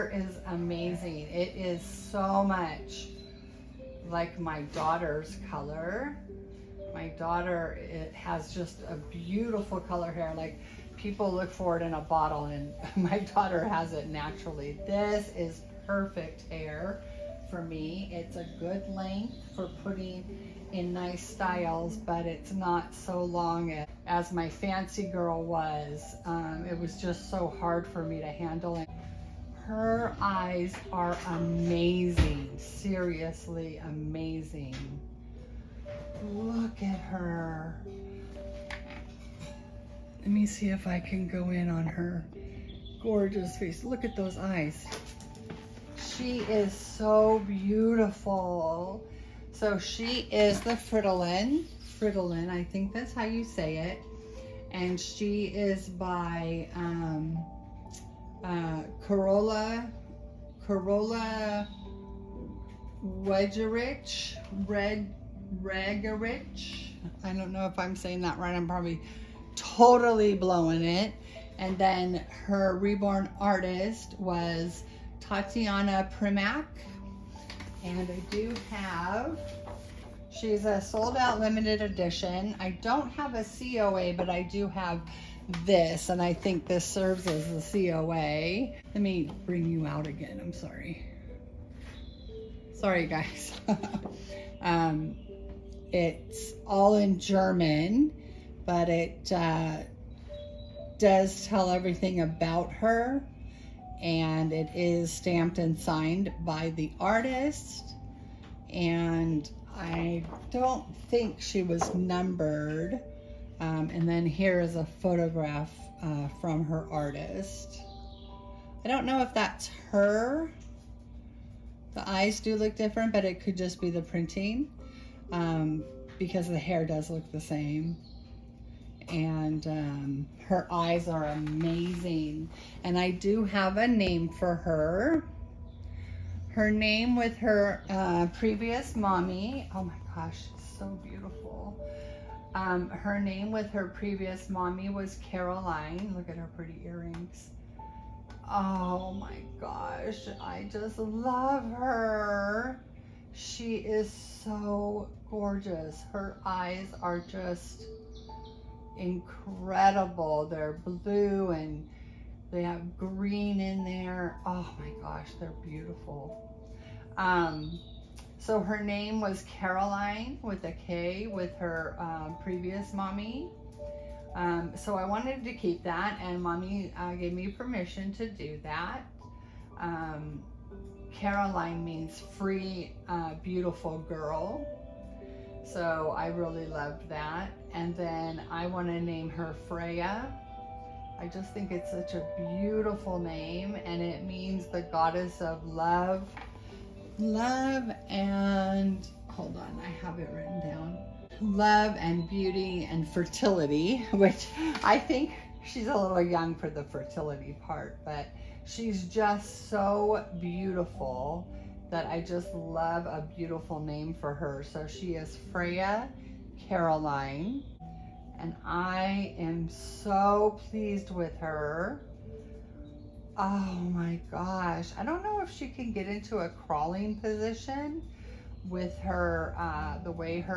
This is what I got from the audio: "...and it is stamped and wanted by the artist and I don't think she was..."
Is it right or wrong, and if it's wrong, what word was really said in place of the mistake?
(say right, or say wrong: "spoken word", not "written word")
wrong: "signed", not "wanted".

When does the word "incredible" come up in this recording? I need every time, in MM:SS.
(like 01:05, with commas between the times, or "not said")
02:38.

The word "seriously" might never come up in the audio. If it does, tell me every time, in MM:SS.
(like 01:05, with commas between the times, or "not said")
00:32.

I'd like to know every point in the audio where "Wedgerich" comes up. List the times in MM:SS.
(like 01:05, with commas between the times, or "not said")
01:03.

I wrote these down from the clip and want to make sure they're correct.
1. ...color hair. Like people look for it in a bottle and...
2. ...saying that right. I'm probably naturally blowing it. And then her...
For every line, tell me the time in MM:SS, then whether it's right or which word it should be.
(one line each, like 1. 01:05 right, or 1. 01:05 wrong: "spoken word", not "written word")
1. 00:09 right
2. 01:07 wrong: "totally", not "naturally".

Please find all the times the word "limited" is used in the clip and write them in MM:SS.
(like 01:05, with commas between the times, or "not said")
01:21.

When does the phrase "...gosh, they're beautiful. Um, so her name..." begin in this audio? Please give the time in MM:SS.
02:45.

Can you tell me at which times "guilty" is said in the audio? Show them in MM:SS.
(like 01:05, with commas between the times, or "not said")
not said.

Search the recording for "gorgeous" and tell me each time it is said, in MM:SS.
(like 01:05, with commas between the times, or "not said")
00:43, 02:35.